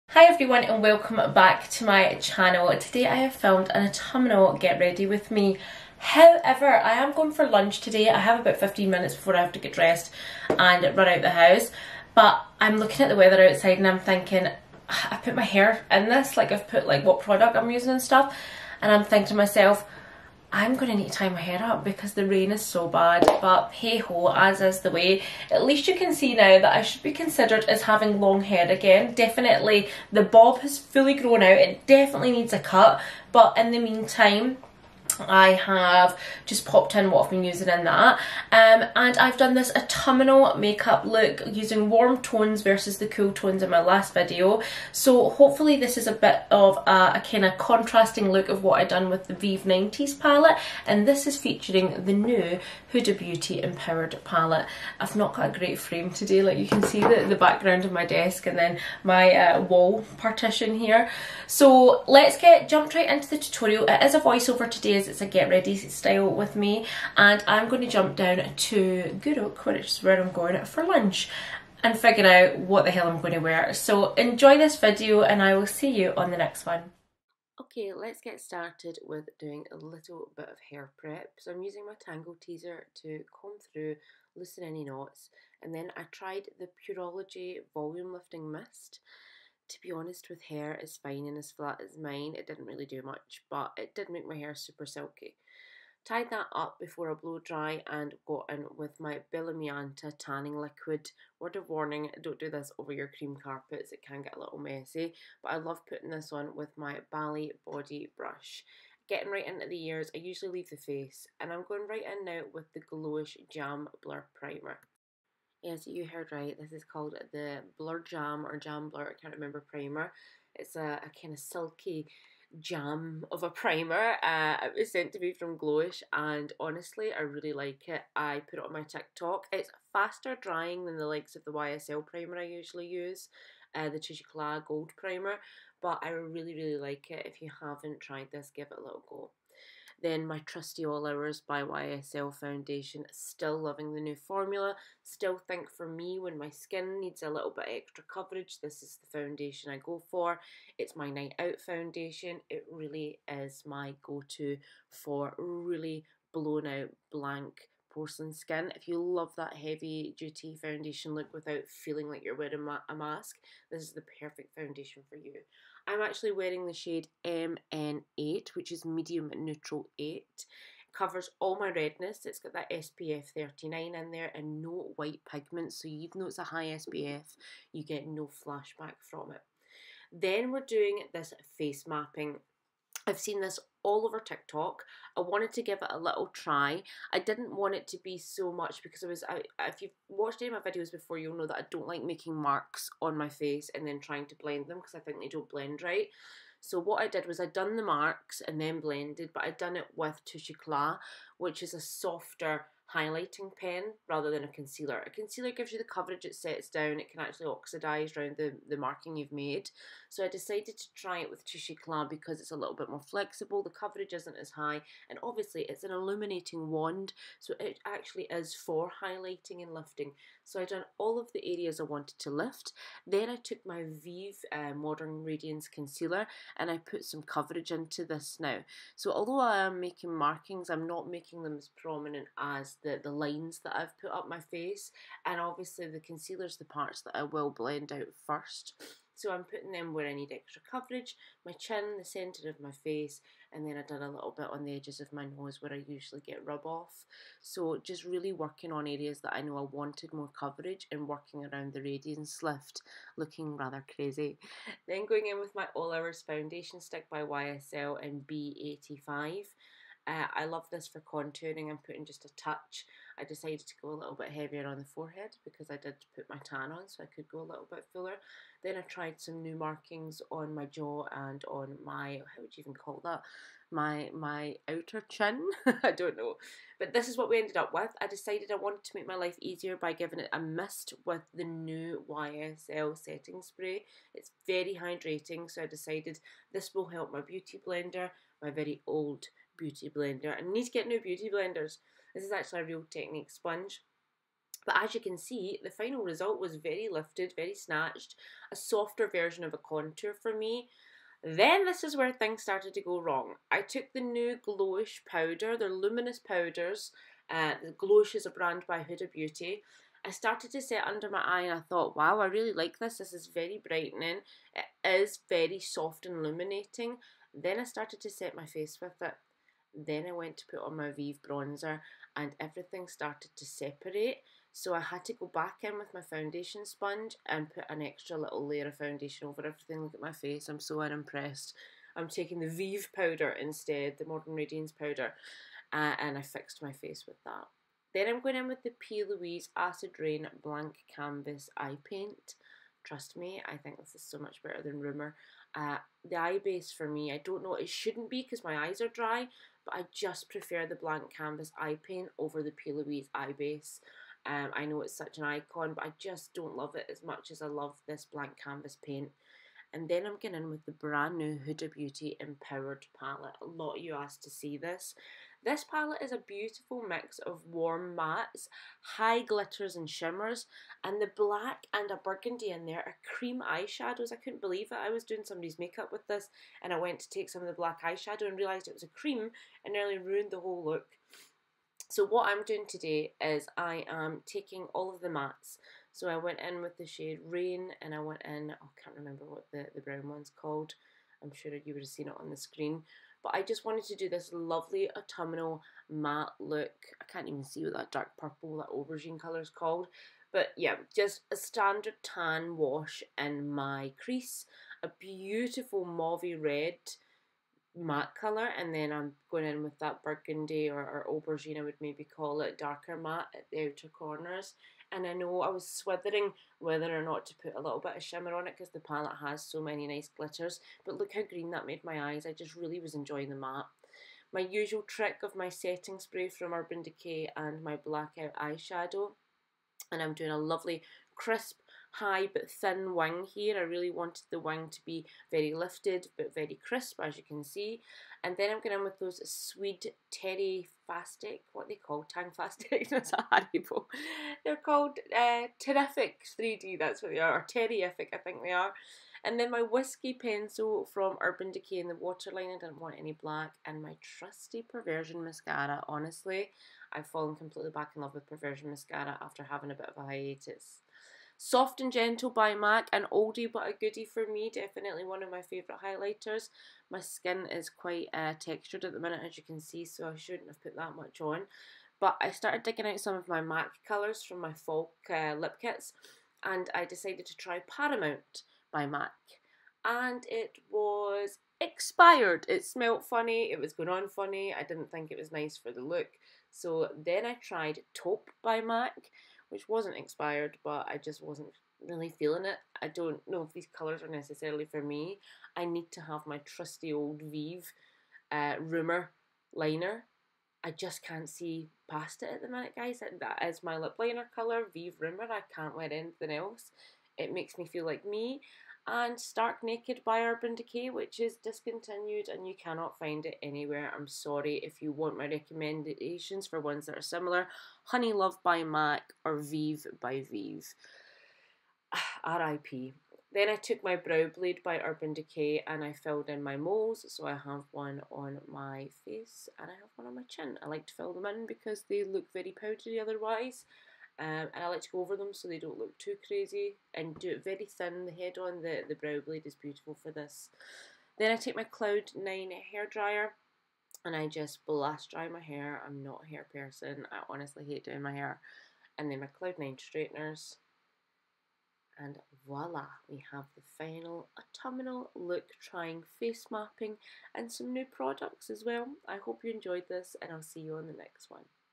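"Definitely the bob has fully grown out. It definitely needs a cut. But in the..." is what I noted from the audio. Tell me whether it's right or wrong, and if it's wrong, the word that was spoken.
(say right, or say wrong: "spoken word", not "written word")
right.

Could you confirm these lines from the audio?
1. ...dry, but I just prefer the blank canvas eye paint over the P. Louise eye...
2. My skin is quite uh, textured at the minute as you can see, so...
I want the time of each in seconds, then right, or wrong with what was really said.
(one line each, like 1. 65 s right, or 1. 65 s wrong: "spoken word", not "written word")
1. 348 s right
2. 466 s right.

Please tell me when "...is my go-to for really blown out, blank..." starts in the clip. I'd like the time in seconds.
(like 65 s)
153 s.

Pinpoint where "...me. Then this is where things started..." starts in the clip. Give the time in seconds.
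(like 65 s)
300 s.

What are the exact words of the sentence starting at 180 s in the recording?
Then we're doing this face mapping I've seen this all over TikTok.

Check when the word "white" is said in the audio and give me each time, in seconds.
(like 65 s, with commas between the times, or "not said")
174 s.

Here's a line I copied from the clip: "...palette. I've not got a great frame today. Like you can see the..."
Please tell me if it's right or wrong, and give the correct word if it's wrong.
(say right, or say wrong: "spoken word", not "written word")
right.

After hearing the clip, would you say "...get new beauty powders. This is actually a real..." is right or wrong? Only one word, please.
wrong.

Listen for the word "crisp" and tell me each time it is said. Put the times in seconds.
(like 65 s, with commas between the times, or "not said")
431 s, 436 s.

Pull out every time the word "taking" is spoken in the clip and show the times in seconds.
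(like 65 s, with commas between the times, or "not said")
332 s, 384 s.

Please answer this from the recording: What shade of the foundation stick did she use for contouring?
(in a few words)
B85.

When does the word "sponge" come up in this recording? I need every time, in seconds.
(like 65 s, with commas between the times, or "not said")
293 s, 326 s.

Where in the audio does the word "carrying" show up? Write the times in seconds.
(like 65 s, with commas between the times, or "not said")
not said.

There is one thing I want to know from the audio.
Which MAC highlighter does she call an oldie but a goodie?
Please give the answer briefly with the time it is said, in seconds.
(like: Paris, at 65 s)
Soft and Gentle, at 461 s.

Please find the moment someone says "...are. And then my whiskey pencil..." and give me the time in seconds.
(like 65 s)
448 s.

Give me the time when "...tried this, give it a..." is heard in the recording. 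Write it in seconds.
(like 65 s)
137 s.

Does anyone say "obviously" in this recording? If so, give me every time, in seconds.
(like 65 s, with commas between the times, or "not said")
215 s, 235 s.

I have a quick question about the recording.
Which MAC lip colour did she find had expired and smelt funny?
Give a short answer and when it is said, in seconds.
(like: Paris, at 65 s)
Paramount, at 477 s.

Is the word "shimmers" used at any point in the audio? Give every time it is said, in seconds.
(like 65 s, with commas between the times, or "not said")
369 s, 418 s.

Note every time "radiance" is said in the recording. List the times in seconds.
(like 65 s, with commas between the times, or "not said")
225 s, 251 s, 334 s.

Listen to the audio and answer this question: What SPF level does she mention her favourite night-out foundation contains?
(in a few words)
39.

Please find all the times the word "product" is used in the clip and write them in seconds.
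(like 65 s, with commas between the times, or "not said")
17 s, 557 s.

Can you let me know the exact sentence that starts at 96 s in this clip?
Tied that up before I blow dry and got in with my Bellamianta tanning liquid.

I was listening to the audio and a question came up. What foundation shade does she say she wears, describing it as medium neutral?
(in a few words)
MN8.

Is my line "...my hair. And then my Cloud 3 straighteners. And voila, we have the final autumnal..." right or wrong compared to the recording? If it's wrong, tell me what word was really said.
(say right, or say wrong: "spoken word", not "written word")
wrong: "9", not "3".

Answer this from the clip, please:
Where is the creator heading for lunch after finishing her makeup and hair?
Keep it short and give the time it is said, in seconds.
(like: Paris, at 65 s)
Guruk, at 69 s.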